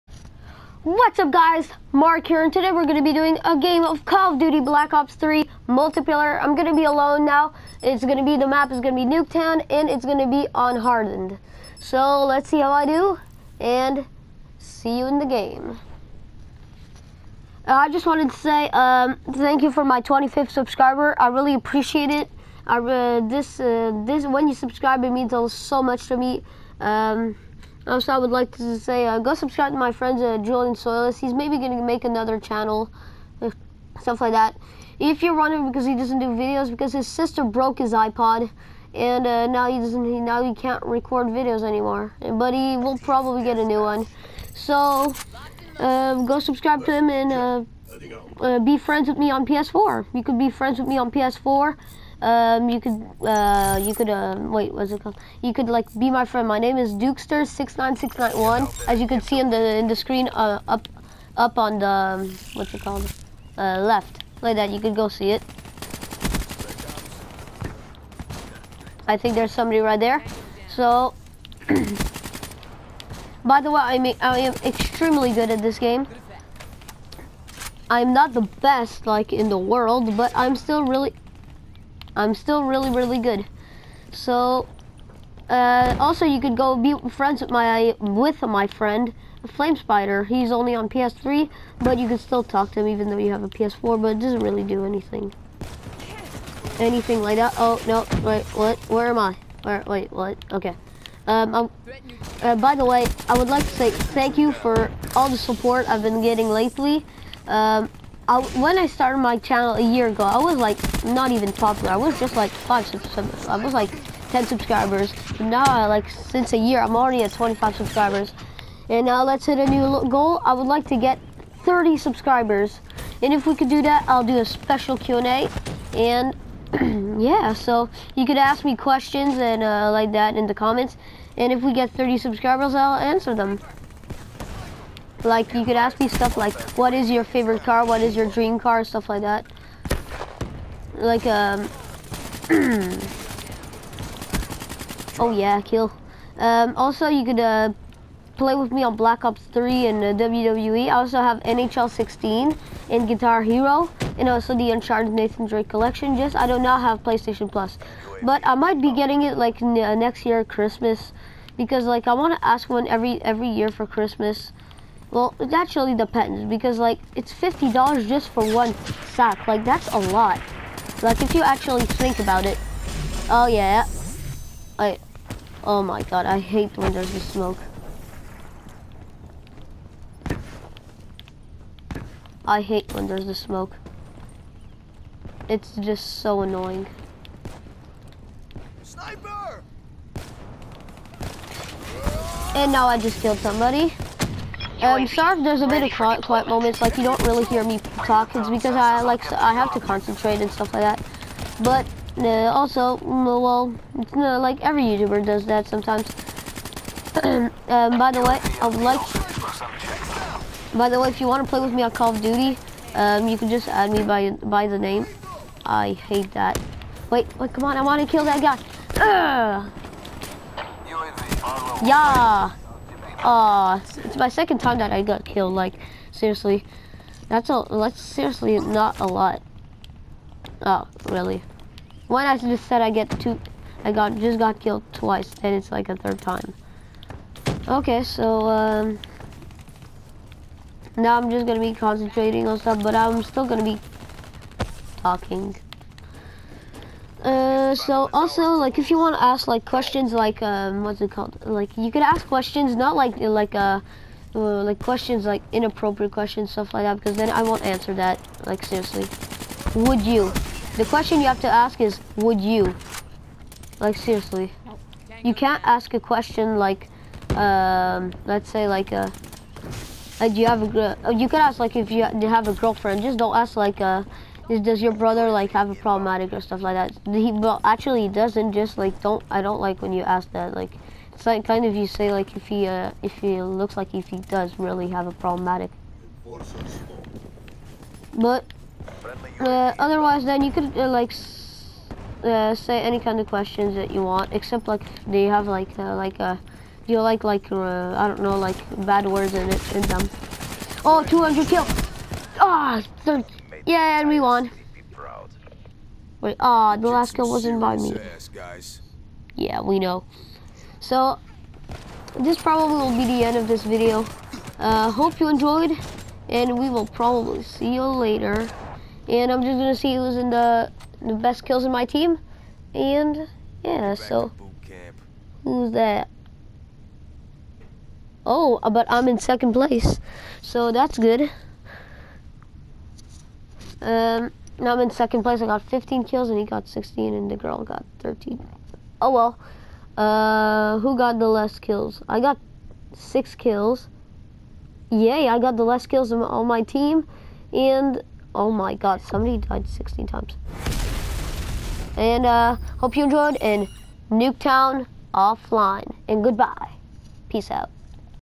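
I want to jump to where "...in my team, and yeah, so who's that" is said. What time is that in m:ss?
5:21.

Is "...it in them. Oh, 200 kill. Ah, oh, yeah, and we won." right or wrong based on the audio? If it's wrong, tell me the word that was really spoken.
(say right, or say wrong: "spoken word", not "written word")
right.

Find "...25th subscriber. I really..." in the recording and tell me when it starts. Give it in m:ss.
0:20.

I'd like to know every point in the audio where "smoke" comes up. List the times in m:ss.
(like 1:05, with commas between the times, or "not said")
2:57, 3:03.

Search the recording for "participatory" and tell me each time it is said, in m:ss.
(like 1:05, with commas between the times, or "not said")
not said.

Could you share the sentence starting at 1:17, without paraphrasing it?
I'm not the best, like, in the world, but I'm still really I'm still really, really good.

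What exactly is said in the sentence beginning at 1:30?
He's only on PS3, but you can still talk to him even though you have a PS4.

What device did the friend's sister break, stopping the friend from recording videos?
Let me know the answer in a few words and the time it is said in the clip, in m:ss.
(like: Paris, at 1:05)
iPod, at 0:37.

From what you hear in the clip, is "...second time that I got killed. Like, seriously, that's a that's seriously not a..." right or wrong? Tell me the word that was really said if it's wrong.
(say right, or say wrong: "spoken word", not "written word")
right.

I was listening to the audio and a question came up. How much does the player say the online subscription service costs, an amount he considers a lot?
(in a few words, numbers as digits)
$50.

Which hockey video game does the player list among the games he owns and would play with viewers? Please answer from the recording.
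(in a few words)
NHL 16.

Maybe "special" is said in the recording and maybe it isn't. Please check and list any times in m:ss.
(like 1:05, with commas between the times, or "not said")
2:04.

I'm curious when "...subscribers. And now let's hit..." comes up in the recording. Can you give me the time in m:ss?
1:57.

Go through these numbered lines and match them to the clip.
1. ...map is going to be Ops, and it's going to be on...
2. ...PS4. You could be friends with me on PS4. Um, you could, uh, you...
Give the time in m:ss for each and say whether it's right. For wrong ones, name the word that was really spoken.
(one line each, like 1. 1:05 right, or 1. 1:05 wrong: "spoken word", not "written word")
1. 0:08 wrong: "Nuketown", not "Ops"
2. 0:49 right.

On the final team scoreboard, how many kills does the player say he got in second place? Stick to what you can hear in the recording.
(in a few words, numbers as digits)
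15.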